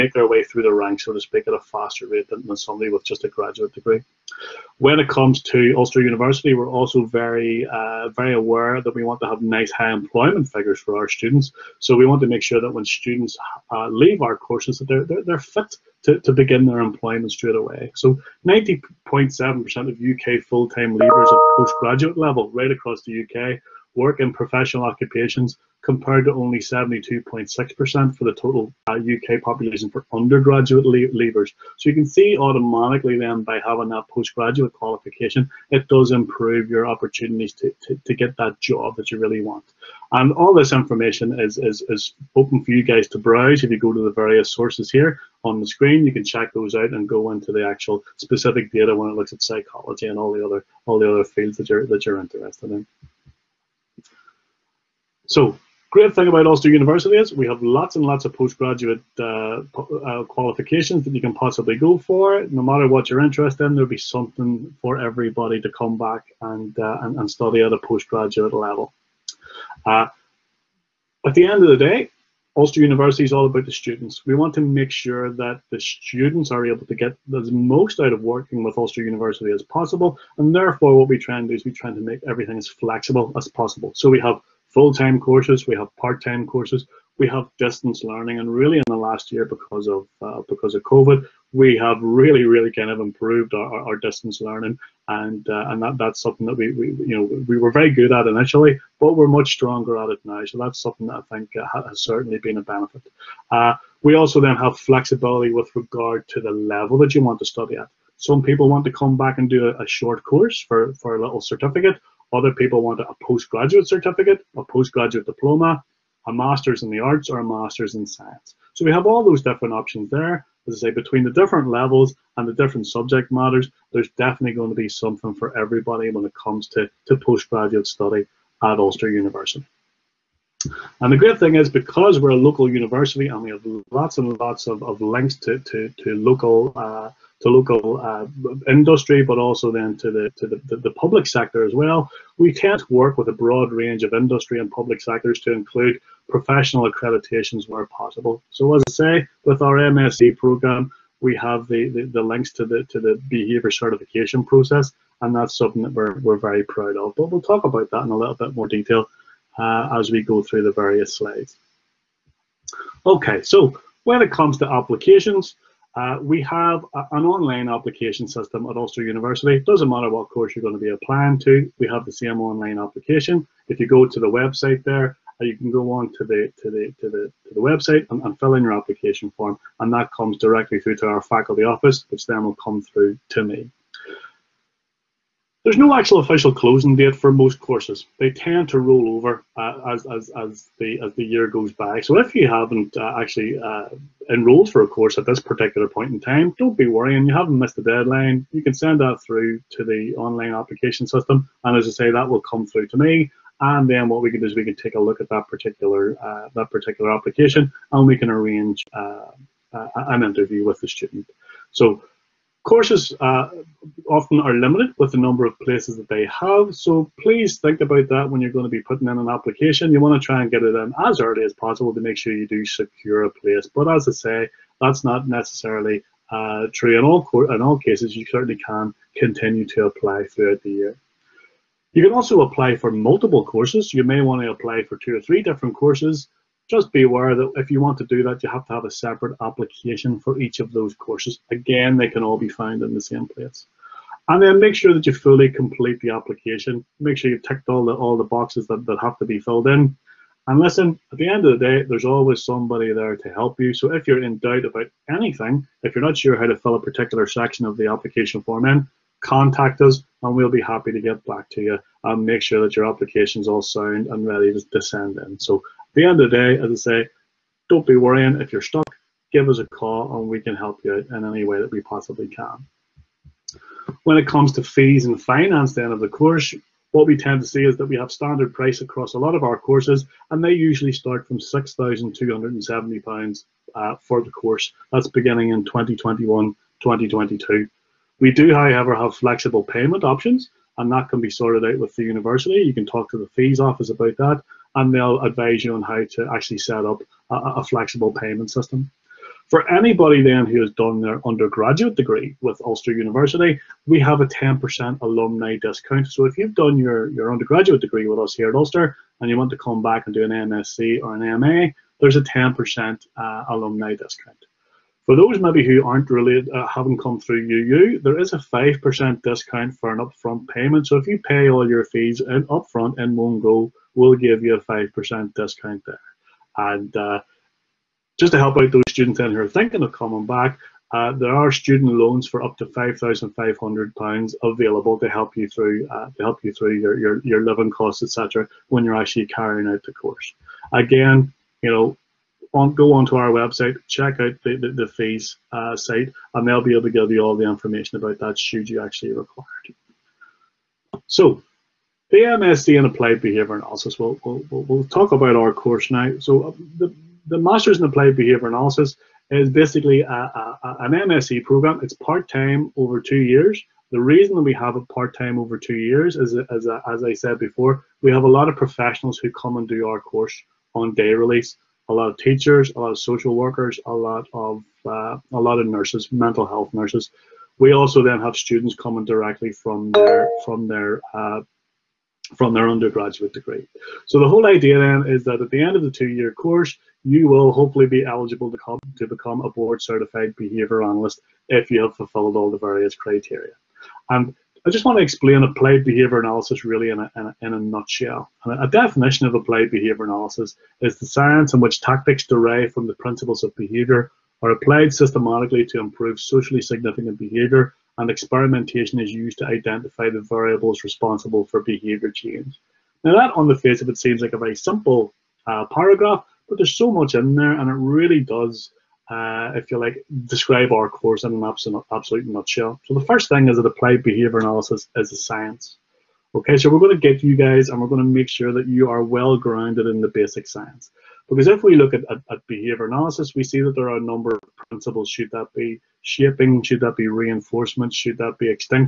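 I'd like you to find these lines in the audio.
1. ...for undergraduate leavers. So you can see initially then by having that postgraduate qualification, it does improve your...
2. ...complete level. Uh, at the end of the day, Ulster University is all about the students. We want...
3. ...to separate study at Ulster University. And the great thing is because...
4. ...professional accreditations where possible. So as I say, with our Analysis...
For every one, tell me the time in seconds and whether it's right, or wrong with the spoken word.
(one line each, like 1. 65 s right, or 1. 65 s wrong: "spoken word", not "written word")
1. 29 s wrong: "automatically", not "initially"
2. 67 s wrong: "postgraduate", not "complete"
3. 127 s wrong: "postgraduate", not "separate"
4. 146 s wrong: "MSc", not "Analysis".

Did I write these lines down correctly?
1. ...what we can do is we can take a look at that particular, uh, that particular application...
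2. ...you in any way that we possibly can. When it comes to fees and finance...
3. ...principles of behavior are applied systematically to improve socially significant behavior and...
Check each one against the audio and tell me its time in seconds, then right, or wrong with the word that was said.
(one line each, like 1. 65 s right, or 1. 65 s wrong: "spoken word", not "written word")
1. 204 s right
2. 270 s right
3. 402 s right.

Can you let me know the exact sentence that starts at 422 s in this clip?
So the first thing is that applied behavior analysis is a science.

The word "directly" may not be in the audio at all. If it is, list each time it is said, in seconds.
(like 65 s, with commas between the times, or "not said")
180 s, 379 s.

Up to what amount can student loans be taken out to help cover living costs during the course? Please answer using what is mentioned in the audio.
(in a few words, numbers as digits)
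£5,500.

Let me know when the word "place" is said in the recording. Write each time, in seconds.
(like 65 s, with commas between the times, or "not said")
215 s, 223 s, 243 s.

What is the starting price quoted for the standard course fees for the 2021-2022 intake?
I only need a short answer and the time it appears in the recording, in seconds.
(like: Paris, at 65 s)
£6,270, at 281 s.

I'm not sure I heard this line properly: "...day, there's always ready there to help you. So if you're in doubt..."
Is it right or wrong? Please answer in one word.
wrong.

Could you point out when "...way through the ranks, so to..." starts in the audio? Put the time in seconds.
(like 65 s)
0 s.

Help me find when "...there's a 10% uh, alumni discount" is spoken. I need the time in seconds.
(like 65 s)
312 s.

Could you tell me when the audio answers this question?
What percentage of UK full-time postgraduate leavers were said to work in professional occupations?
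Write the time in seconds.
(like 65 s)
18 s.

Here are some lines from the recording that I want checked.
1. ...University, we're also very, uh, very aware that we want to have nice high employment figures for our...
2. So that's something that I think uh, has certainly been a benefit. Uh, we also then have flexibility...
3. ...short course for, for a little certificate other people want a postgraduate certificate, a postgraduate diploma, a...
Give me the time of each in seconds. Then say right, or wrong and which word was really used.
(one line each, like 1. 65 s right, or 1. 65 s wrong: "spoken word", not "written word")
1. 6 s right
2. 100 s right
3. 109 s right.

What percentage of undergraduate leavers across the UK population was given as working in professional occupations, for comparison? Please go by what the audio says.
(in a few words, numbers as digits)
72.6%.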